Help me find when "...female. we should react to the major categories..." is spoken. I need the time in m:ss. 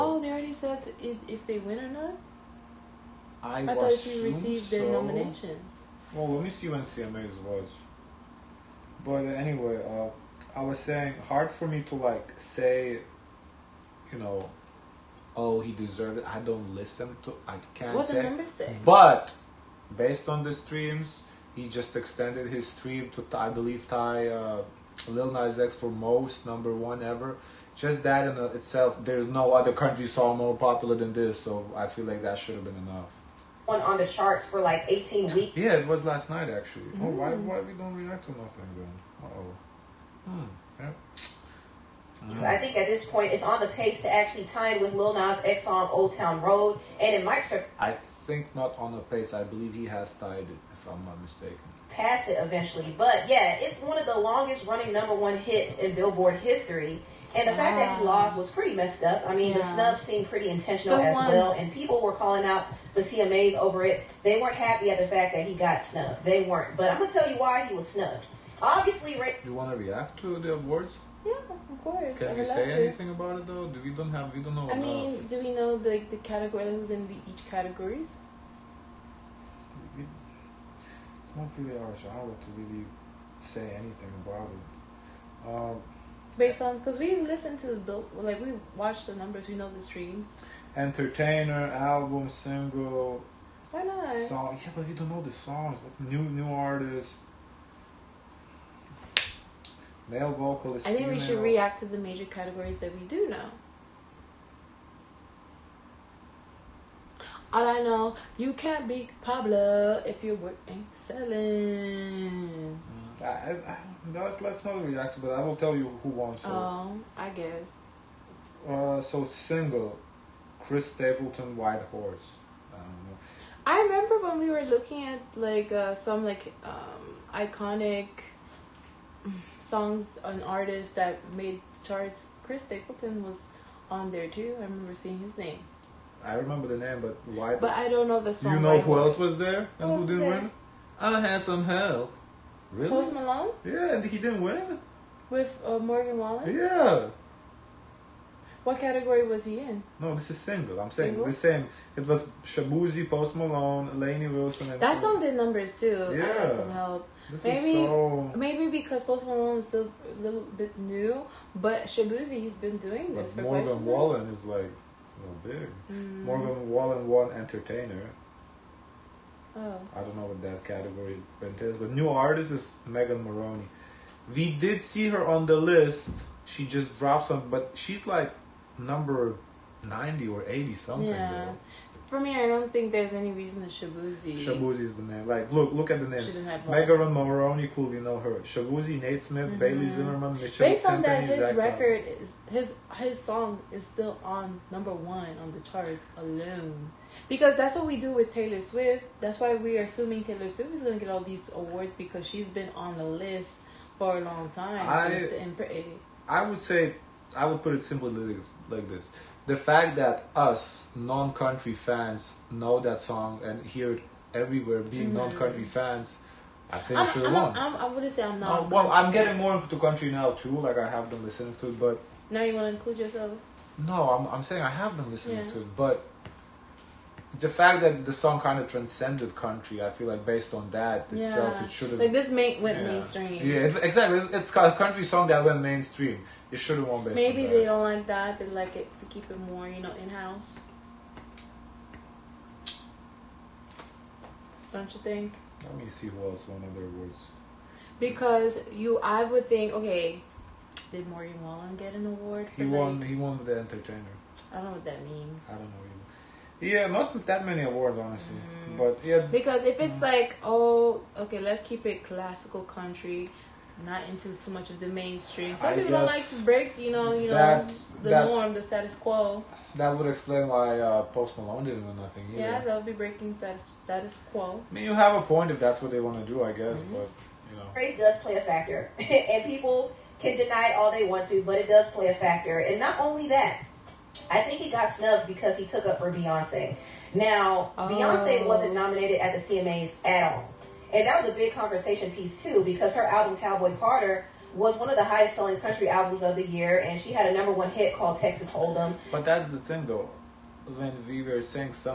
1:41.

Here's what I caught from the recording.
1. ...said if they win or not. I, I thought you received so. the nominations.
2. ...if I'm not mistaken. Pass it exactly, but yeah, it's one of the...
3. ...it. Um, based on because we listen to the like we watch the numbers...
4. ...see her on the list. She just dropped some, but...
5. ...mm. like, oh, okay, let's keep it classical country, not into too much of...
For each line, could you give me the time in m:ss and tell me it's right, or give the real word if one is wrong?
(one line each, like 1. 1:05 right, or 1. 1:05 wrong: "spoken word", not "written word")
1. 0:00 right
2. 0:50 wrong: "eventually", not "exactly"
3. 1:24 right
4. 2:54 right
5. 4:19 right.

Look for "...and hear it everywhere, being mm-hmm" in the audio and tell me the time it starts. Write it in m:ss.
3:33.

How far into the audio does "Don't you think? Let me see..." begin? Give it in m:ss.
4:04.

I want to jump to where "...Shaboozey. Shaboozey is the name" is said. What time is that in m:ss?
3:03.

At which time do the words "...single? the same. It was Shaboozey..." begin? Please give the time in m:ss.
2:31.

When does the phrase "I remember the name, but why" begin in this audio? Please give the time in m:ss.
2:16.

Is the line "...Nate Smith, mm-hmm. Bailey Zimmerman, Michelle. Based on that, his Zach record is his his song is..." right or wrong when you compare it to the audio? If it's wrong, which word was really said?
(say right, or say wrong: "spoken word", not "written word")
right.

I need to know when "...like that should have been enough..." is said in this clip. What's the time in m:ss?
0:32.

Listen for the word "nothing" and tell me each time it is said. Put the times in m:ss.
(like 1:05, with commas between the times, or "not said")
0:38, 4:32.